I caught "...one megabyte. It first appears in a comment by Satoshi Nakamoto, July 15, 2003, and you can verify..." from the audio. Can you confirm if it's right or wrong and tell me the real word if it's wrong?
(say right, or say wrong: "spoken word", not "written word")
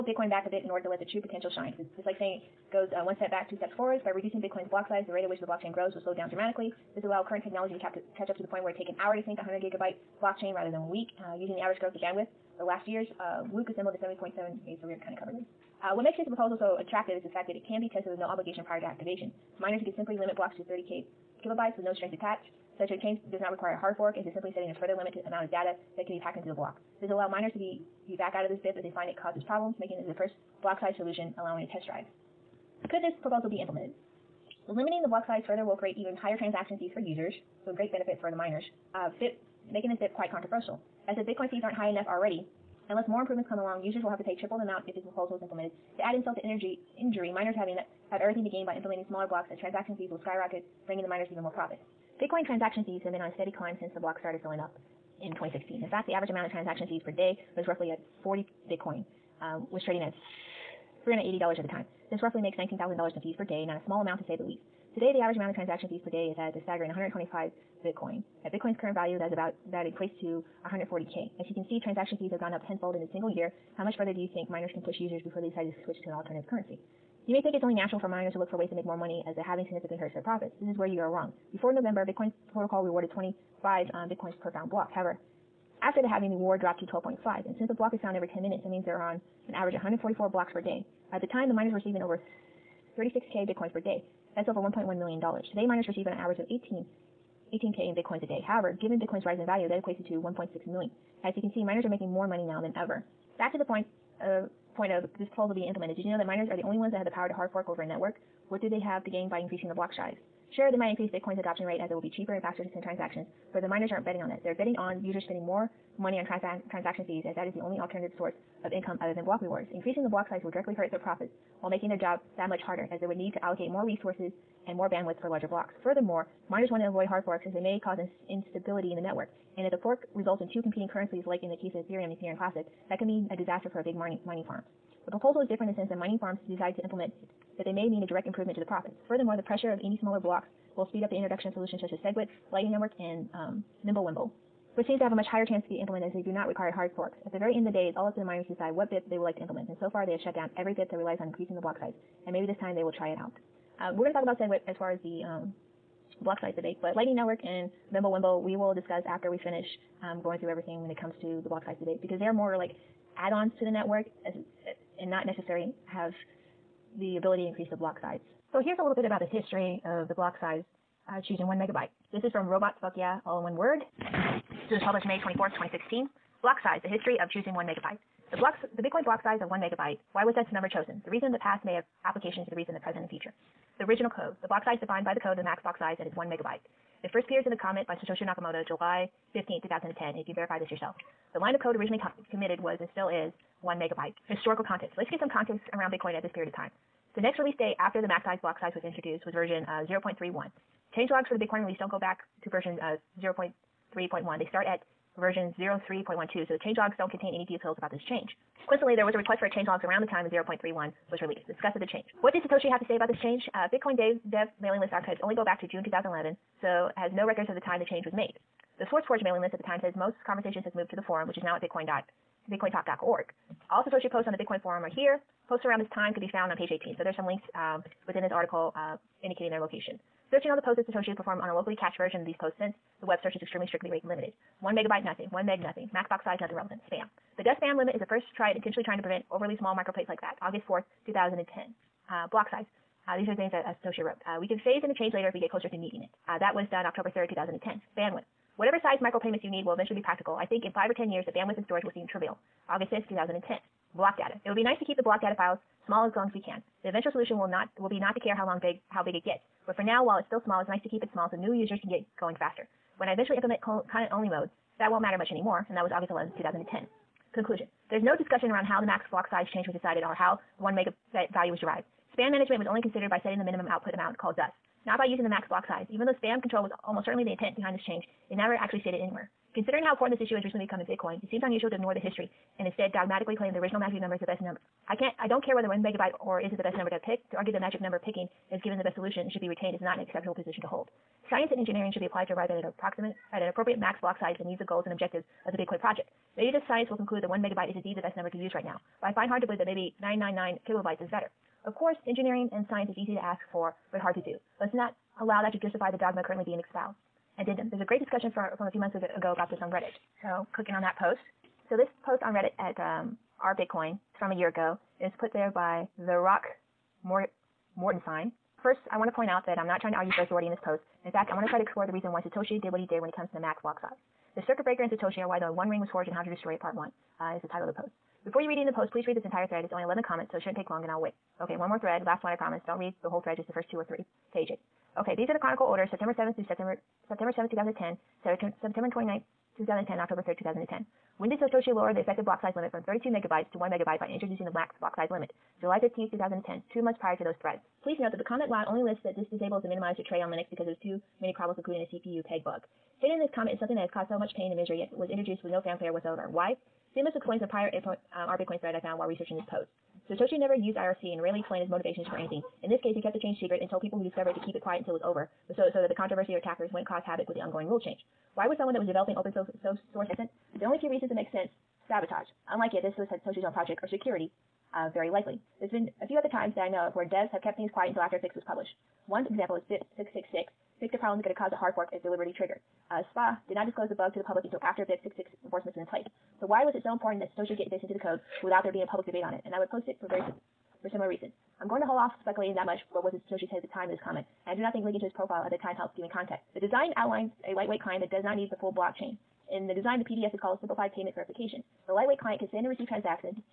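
wrong: "2010", not "2003".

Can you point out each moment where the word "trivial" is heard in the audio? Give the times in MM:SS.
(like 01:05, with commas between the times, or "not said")
04:12.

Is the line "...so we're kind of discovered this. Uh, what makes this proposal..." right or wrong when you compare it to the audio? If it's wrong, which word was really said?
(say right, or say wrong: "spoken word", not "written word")
wrong: "covered", not "discovered".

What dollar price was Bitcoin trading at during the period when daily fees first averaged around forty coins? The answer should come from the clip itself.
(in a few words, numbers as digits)
$380.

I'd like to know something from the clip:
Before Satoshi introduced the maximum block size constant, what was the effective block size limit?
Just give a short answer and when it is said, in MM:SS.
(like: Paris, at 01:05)
32 megabytes, at 05:42.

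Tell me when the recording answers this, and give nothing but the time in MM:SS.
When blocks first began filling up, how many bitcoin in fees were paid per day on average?
00:58.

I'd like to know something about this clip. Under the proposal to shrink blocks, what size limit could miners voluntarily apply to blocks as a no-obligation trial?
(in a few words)
30 kilobytes.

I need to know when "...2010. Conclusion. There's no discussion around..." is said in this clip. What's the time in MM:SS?
04:26.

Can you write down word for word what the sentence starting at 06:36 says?
The design outlines a lightweight client that does not need the full blockchain.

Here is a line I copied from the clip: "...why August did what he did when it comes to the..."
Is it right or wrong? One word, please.
wrong.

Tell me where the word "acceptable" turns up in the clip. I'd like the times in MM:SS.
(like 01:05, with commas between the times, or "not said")
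04:50.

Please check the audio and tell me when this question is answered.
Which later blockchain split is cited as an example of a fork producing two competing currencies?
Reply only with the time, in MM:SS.
02:12.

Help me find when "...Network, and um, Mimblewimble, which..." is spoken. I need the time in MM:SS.
02:22.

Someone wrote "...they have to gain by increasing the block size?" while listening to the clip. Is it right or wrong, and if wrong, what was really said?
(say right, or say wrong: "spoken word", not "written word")
right.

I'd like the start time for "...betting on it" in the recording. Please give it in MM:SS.
01:54.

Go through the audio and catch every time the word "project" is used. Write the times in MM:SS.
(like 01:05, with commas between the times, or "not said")
04:55, 06:13.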